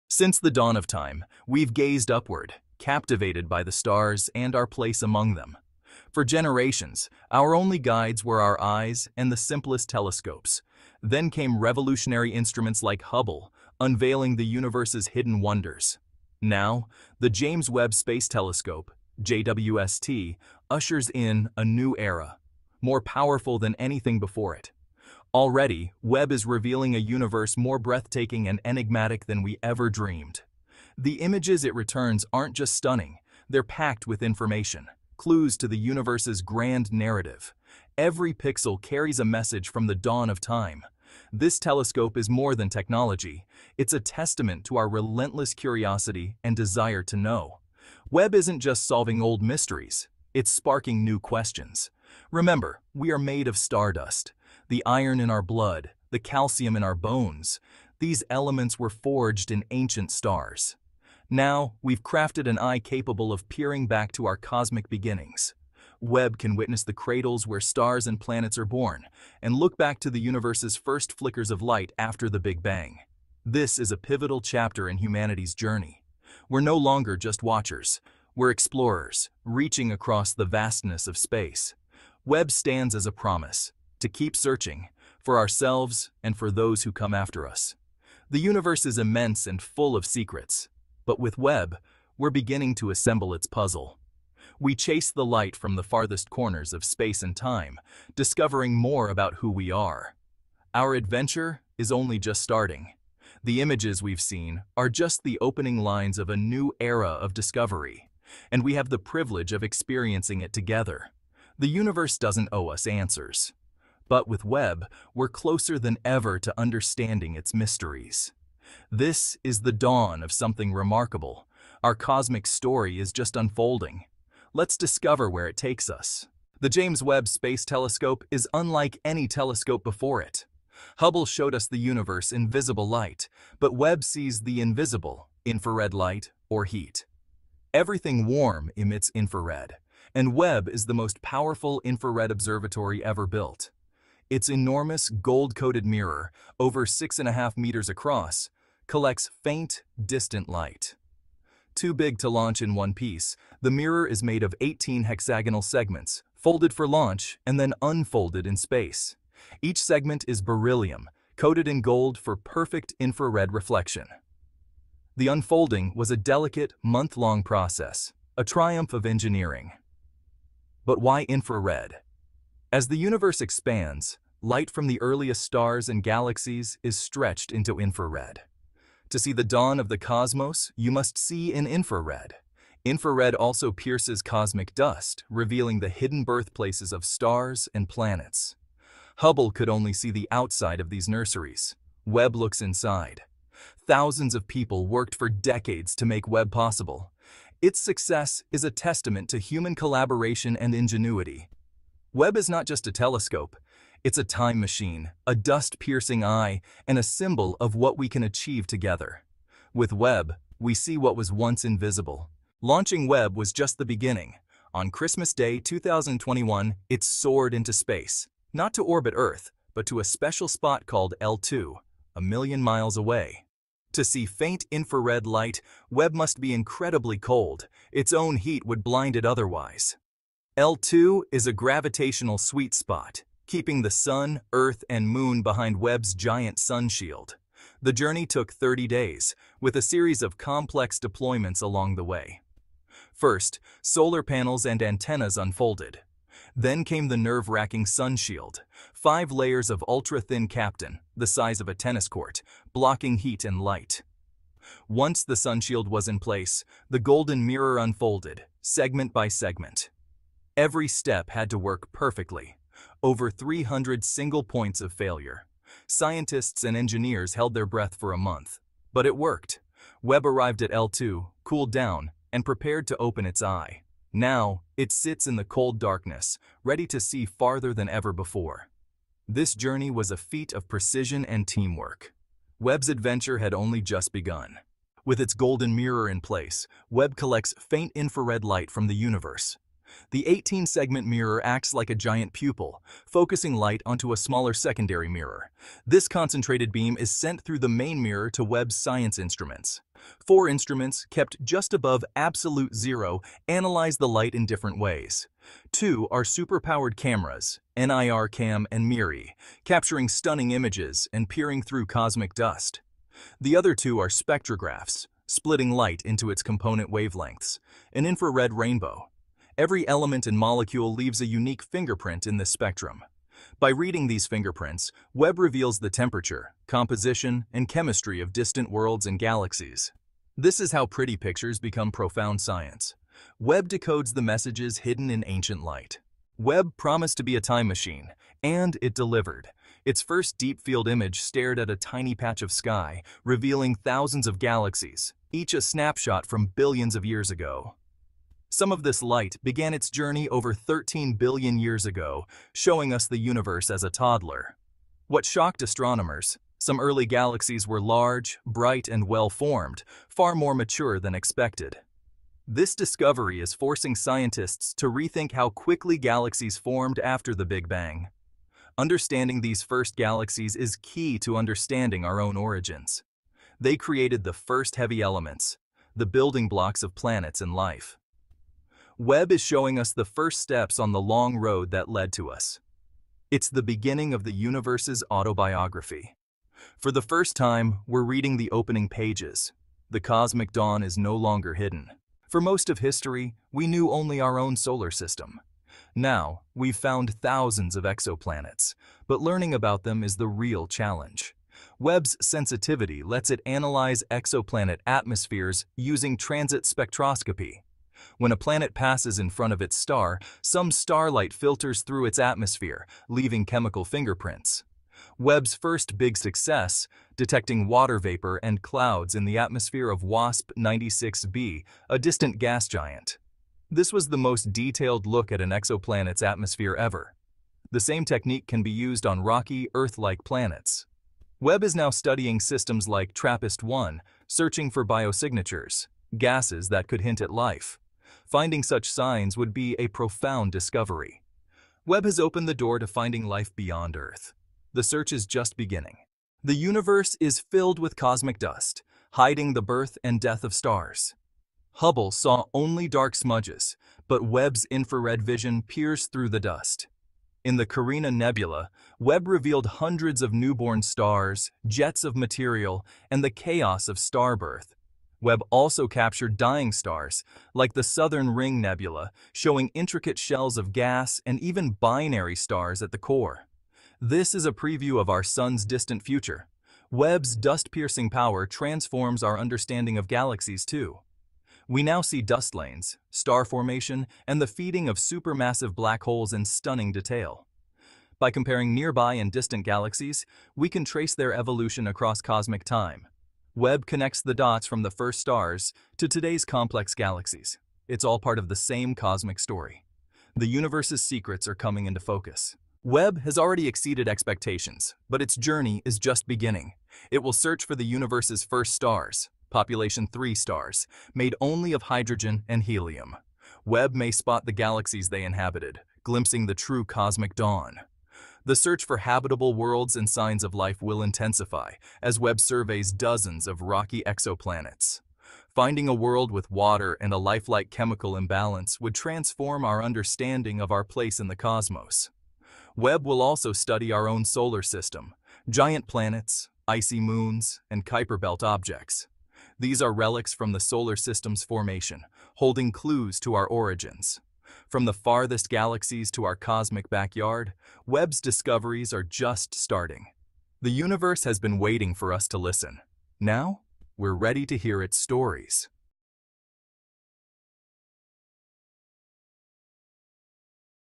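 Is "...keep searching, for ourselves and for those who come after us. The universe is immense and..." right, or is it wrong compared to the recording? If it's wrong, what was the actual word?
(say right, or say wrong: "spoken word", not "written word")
right.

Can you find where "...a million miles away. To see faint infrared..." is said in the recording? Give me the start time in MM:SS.
03:42.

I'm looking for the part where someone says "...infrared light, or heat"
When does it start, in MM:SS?
02:15.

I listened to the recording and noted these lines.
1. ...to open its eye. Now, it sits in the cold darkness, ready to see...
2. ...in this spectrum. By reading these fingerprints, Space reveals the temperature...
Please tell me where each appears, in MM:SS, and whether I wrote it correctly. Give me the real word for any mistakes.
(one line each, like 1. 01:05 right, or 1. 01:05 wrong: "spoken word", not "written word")
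1. 04:32 right
2. 05:22 wrong: "Webb", not "Space".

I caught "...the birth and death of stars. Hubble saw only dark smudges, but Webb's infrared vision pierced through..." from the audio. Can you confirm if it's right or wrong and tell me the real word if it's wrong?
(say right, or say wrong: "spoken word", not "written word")
right.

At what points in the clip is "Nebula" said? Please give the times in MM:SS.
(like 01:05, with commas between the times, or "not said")
07:38, 07:48.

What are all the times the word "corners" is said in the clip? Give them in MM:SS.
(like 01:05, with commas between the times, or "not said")
01:36.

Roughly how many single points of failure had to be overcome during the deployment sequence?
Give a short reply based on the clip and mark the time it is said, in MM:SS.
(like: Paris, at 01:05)
300, at 04:23.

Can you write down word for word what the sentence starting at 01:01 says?
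Now, we've crafted an eye capable of peering back to our cosmic beginnings.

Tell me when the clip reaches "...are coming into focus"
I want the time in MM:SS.
08:21.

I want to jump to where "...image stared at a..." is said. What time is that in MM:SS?
05:40.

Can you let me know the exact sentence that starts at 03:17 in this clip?
Its success is a testament to human collaboration and ingenuity.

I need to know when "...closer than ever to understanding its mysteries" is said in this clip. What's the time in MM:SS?
01:55.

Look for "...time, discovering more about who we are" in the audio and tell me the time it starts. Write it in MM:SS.
01:37.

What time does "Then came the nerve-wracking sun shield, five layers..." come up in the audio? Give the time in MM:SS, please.
04:06.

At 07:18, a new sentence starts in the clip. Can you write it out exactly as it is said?
Finding such signs would be a profound discovery.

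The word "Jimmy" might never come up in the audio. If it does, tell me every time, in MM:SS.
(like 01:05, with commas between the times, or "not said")
not said.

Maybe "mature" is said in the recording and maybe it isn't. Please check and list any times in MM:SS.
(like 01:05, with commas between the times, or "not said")
06:00.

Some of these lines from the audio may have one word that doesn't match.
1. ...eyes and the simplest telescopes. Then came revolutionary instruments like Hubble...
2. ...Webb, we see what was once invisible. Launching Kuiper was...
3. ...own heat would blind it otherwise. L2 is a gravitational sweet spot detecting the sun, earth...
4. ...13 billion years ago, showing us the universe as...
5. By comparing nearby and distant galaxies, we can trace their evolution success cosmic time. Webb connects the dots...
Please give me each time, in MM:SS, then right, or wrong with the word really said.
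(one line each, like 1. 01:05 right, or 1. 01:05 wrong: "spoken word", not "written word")
1. 00:08 right
2. 03:29 wrong: "Webb", not "Kuiper"
3. 03:48 wrong: "keeping", not "detecting"
4. 05:50 right
5. 08:08 wrong: "across", not "success".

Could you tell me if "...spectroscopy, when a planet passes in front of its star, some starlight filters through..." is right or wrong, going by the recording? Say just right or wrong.
right.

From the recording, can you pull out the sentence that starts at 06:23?
It's the beginning of the universe's autobiography.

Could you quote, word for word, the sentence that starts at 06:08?
Understanding these first galaxies is key to understanding our own origins.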